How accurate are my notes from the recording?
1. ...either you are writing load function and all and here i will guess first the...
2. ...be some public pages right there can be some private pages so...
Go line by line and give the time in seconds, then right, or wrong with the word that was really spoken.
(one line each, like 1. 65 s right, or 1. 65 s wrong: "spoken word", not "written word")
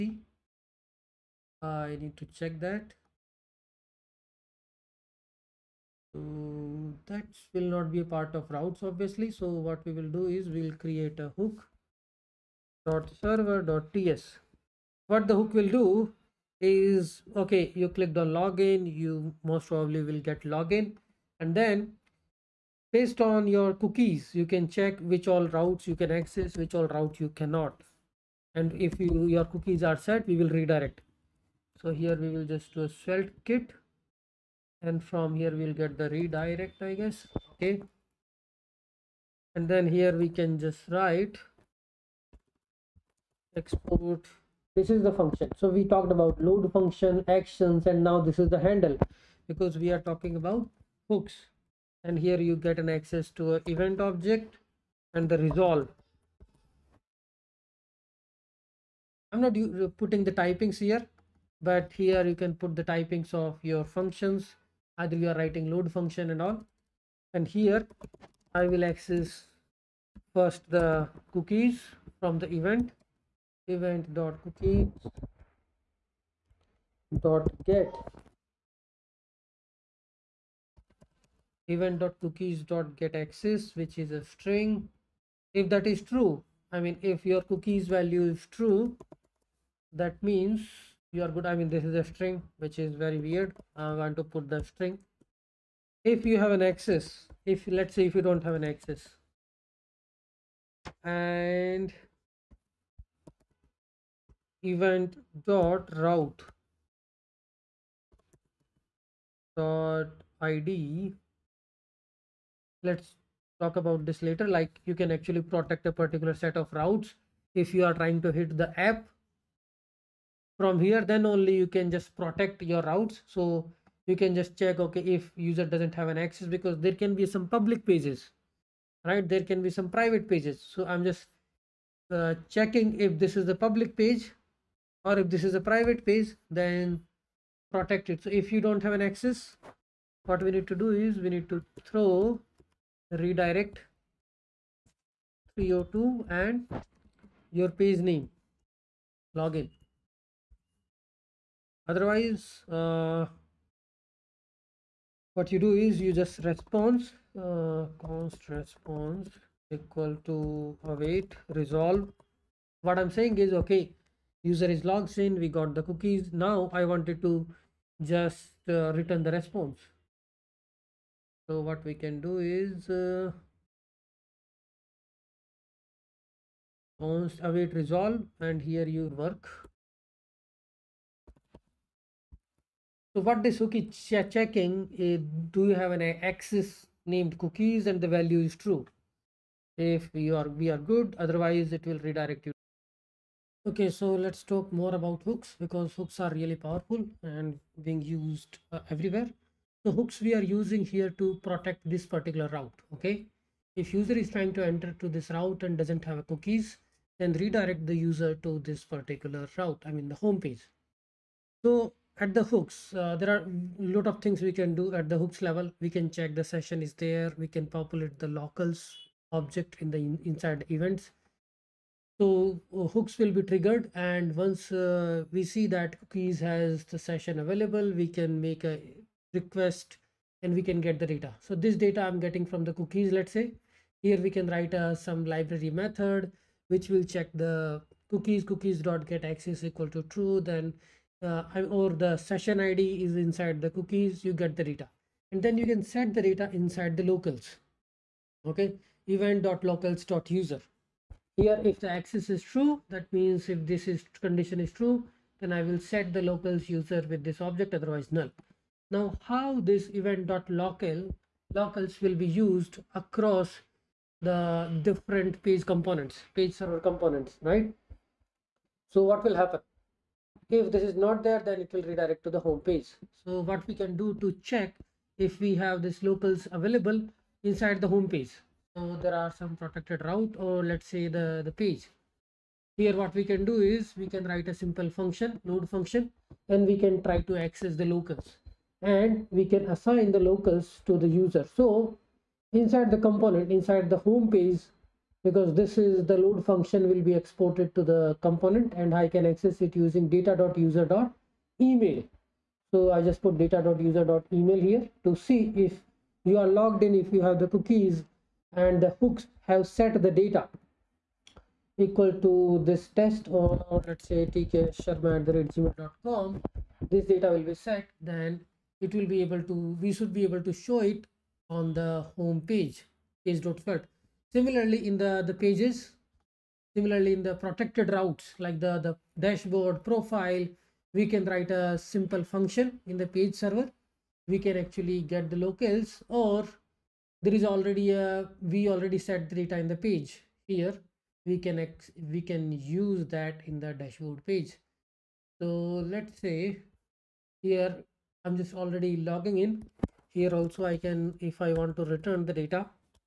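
1. 64 s wrong: "access", not "guess"
2. 127 s right.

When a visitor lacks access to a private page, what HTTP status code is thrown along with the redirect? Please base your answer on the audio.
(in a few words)
302.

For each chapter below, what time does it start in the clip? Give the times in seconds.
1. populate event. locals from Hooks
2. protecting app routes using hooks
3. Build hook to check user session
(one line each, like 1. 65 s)
1. 261 s
2. 191 s
3. 21 s.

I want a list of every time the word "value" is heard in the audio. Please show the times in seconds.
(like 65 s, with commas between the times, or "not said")
87 s, 188 s.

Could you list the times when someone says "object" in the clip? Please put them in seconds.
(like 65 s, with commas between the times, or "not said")
53 s, 219 s, 257 s.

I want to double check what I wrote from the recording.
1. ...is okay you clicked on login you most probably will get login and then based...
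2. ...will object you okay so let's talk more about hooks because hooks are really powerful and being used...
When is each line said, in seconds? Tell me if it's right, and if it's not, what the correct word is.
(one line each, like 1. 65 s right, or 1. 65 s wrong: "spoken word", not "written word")
1. 16 s right
2. 191 s wrong: "redirect", not "object".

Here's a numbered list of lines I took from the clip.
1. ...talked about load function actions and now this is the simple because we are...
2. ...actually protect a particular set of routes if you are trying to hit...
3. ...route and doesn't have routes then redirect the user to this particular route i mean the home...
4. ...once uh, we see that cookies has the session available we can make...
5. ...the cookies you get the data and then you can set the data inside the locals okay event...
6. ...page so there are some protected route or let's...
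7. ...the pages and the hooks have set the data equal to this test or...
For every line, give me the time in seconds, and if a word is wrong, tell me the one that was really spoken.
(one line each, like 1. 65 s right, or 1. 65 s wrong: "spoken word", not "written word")
1. 45 s wrong: "handle", not "simple"
2. 115 s right
3. 205 s wrong: "cookies", not "routes"
4. 224 s right
5. 243 s right
6. 278 s right
7. 307 s wrong: "cookies", not "pages".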